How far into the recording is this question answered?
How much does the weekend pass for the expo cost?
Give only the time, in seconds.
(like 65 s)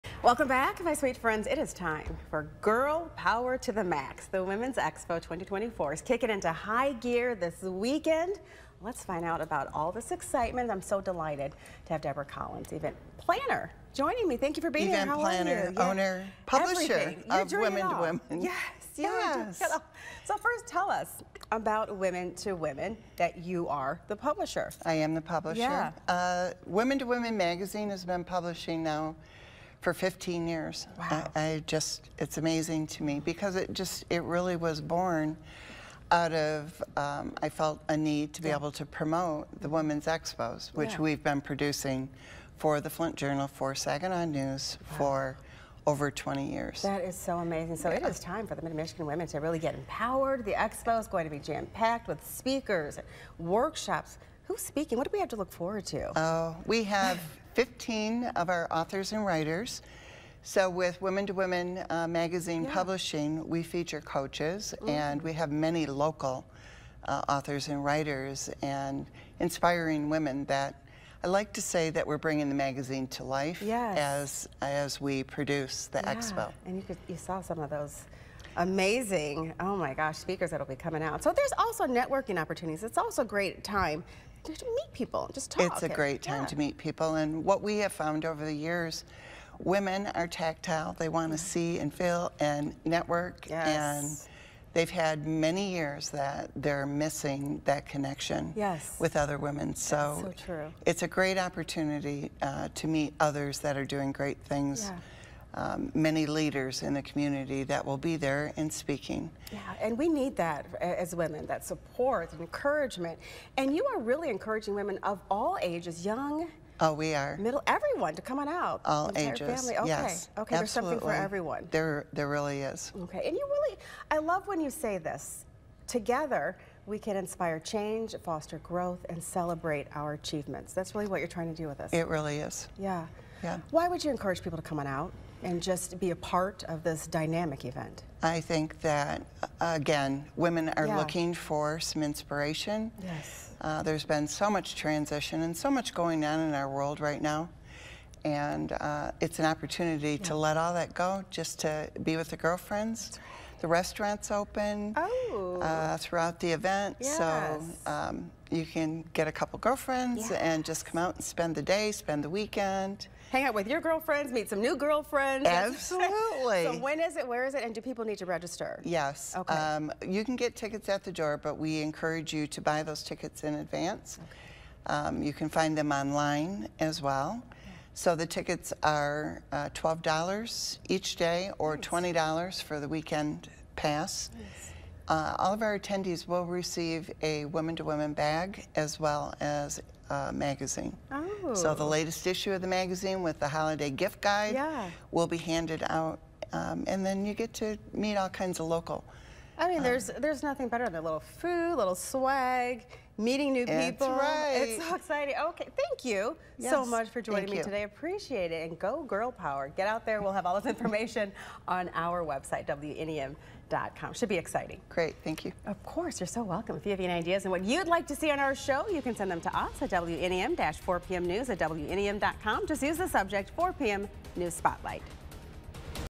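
181 s.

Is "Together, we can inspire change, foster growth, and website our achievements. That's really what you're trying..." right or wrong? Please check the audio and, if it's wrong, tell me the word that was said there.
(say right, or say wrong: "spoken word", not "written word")
wrong: "celebrate", not "website".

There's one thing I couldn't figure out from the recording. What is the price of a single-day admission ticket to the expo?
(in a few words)
$12.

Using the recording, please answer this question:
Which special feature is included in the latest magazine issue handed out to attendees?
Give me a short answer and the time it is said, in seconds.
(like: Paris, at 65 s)
holiday gift guide, at 193 s.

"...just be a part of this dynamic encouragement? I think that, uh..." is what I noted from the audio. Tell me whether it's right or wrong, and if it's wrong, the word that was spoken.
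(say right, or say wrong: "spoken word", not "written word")
wrong: "event", not "encouragement".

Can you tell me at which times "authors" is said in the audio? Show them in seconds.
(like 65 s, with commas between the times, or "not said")
58 s, 67 s.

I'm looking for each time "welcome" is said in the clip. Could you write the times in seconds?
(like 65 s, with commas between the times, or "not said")
0 s, 216 s.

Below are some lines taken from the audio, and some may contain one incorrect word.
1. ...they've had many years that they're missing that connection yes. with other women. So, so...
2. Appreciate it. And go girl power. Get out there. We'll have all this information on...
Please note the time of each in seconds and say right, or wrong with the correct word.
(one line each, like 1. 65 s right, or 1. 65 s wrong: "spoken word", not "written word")
1. 94 s right
2. 207 s right.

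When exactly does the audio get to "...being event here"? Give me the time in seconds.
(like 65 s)
14 s.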